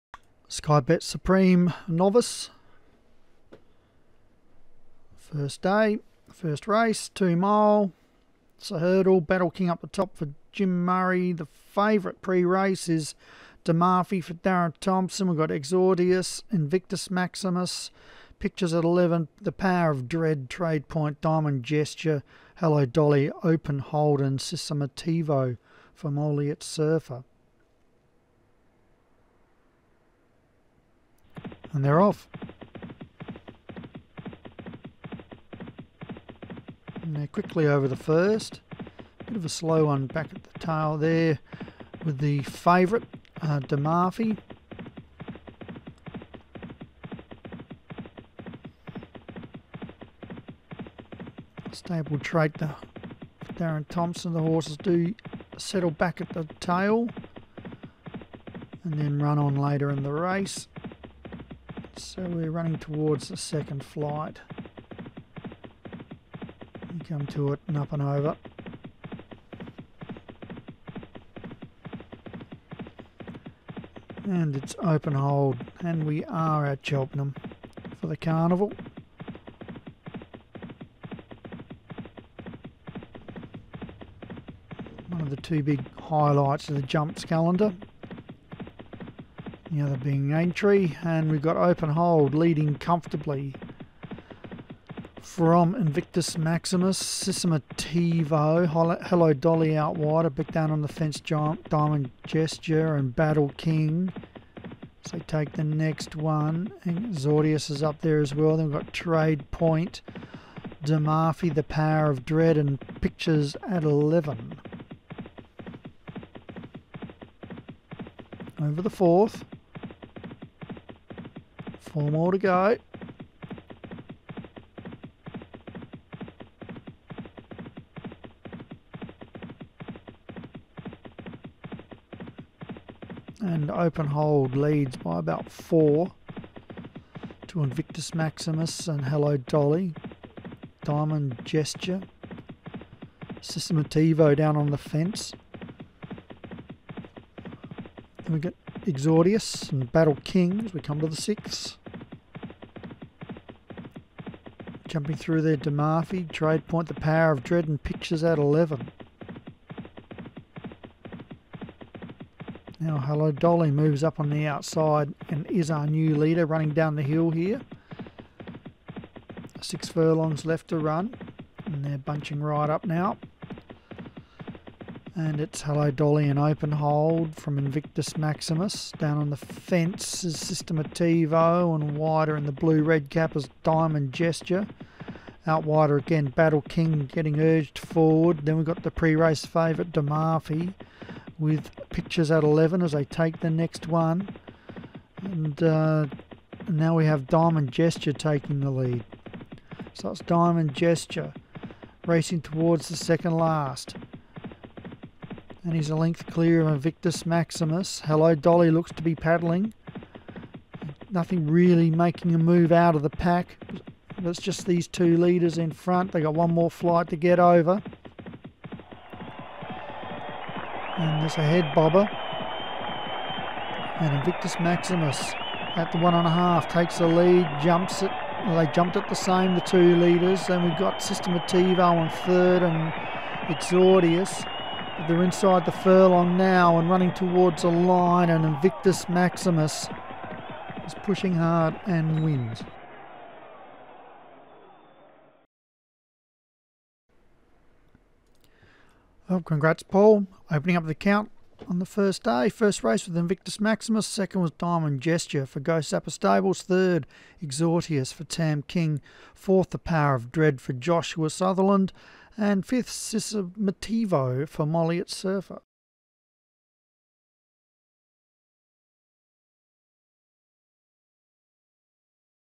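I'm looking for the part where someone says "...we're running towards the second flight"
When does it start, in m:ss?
1:02.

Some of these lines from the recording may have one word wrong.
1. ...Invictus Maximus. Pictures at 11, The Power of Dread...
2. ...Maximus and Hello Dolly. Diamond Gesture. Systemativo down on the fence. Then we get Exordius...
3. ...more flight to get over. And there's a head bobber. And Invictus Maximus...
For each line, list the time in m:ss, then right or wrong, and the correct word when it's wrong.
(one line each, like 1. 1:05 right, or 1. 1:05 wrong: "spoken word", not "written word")
1. 0:16 right
2. 2:18 right
3. 3:36 right.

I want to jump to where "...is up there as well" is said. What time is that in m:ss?
1:47.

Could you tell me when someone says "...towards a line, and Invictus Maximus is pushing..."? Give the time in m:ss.
3:57.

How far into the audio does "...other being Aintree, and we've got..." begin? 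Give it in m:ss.
1:29.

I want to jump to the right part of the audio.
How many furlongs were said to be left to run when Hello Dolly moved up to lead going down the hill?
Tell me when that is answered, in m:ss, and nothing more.
2:49.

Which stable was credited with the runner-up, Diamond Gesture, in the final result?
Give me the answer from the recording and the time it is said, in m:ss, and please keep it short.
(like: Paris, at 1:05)
Ghost Zapper Stables, at 4:15.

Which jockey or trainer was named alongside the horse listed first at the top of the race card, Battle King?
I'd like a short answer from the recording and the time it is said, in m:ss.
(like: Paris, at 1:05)
Jim Murray, at 0:10.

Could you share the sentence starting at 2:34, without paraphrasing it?
Jumping through there, DeMarfi, trade point, the power of dread, and pictures at 11.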